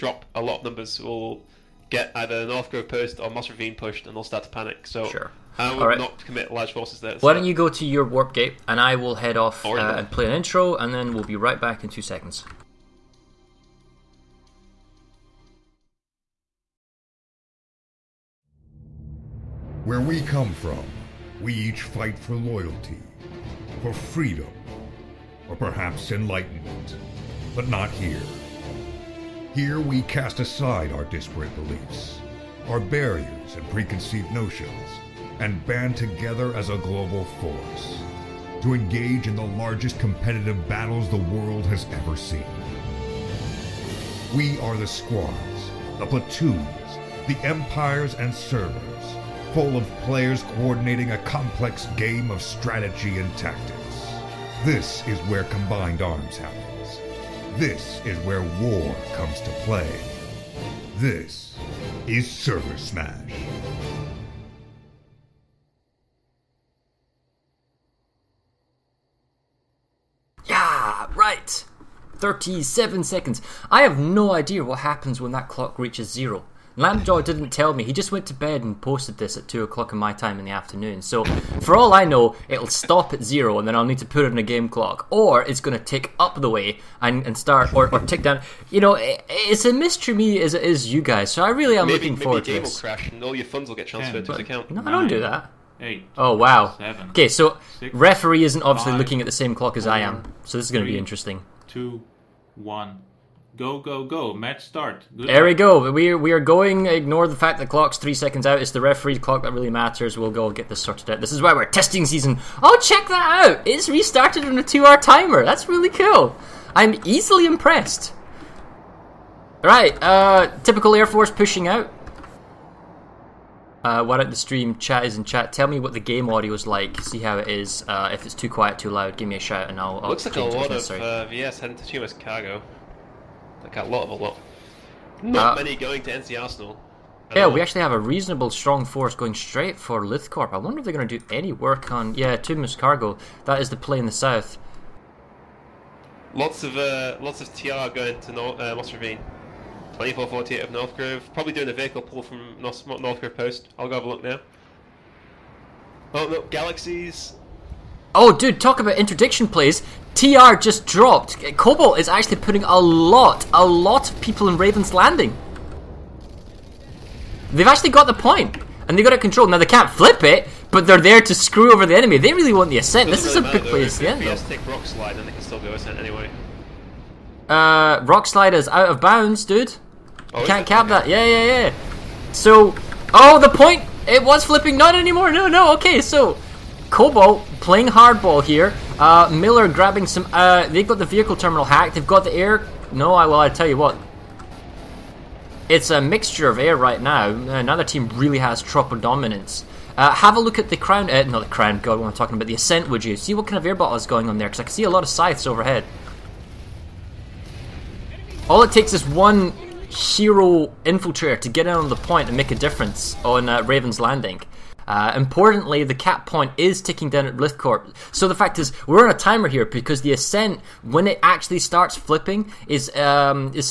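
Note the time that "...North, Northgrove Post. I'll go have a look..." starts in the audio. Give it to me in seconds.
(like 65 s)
152 s.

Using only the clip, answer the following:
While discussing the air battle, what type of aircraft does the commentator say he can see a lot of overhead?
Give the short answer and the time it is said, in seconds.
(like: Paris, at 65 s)
Scythes, at 205 s.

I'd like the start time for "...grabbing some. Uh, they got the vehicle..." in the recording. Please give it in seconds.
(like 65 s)
189 s.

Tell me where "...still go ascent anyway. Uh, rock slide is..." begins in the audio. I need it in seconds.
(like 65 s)
175 s.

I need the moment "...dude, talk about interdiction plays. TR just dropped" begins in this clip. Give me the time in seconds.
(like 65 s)
158 s.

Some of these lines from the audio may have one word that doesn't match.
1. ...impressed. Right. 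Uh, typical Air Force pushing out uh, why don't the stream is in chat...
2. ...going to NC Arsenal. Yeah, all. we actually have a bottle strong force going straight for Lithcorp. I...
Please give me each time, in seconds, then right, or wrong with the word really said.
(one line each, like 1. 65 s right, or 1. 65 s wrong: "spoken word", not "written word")
1. 117 s right
2. 135 s wrong: "reasonable", not "bottle".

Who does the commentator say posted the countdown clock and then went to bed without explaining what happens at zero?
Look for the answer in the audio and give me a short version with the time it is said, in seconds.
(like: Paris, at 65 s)
Lampjaw, at 76 s.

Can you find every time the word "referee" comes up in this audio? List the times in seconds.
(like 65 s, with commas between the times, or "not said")
97 s, 108 s.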